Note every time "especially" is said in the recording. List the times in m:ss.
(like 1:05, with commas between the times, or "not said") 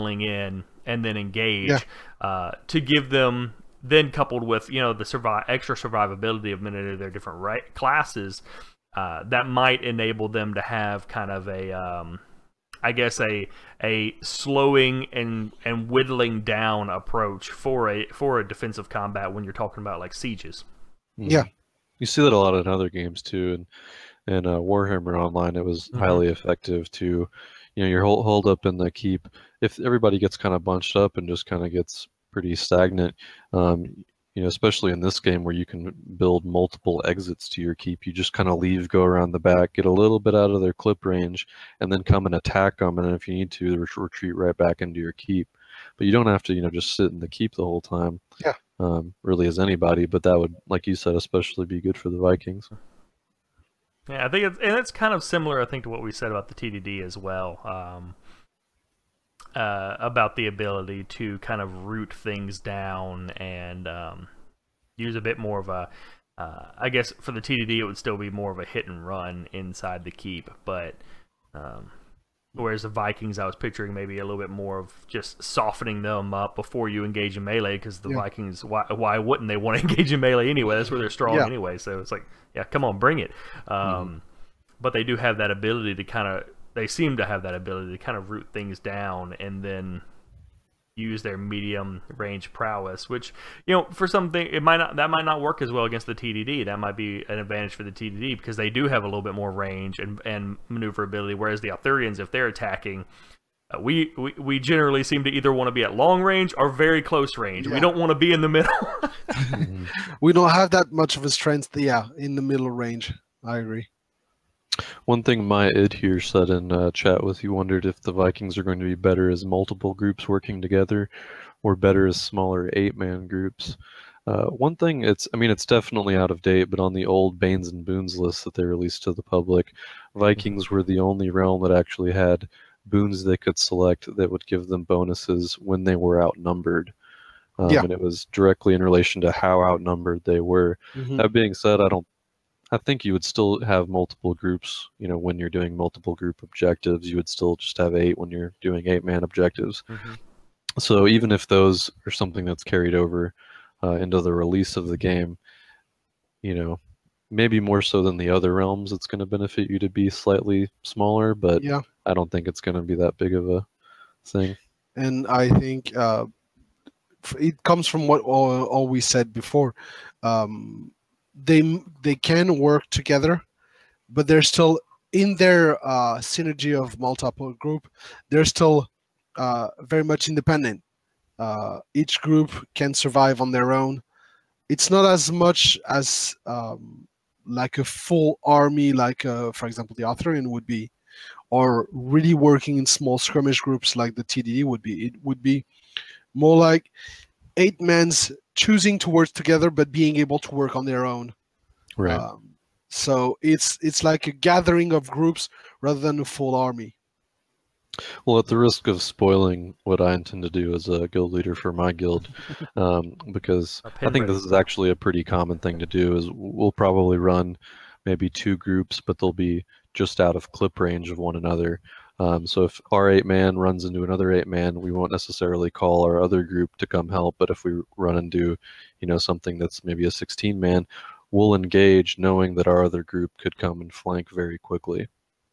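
0:34, 0:51.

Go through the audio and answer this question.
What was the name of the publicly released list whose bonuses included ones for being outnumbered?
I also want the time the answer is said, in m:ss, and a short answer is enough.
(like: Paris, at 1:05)
Banes and Boons, at 2:07.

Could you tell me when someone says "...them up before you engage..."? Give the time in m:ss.
1:16.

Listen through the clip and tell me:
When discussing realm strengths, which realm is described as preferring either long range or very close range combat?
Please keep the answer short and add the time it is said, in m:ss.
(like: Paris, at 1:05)
Arthurians, at 1:41.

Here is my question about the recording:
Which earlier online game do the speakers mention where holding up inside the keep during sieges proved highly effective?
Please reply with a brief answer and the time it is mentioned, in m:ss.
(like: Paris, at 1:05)
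Warhammer Online, at 0:24.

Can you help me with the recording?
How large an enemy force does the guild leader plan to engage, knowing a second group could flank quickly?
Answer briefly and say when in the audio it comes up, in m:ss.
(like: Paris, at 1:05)
16 man, at 3:50.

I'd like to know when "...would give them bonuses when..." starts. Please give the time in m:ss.
2:14.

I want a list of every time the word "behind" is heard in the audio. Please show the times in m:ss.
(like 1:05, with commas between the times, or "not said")
not said.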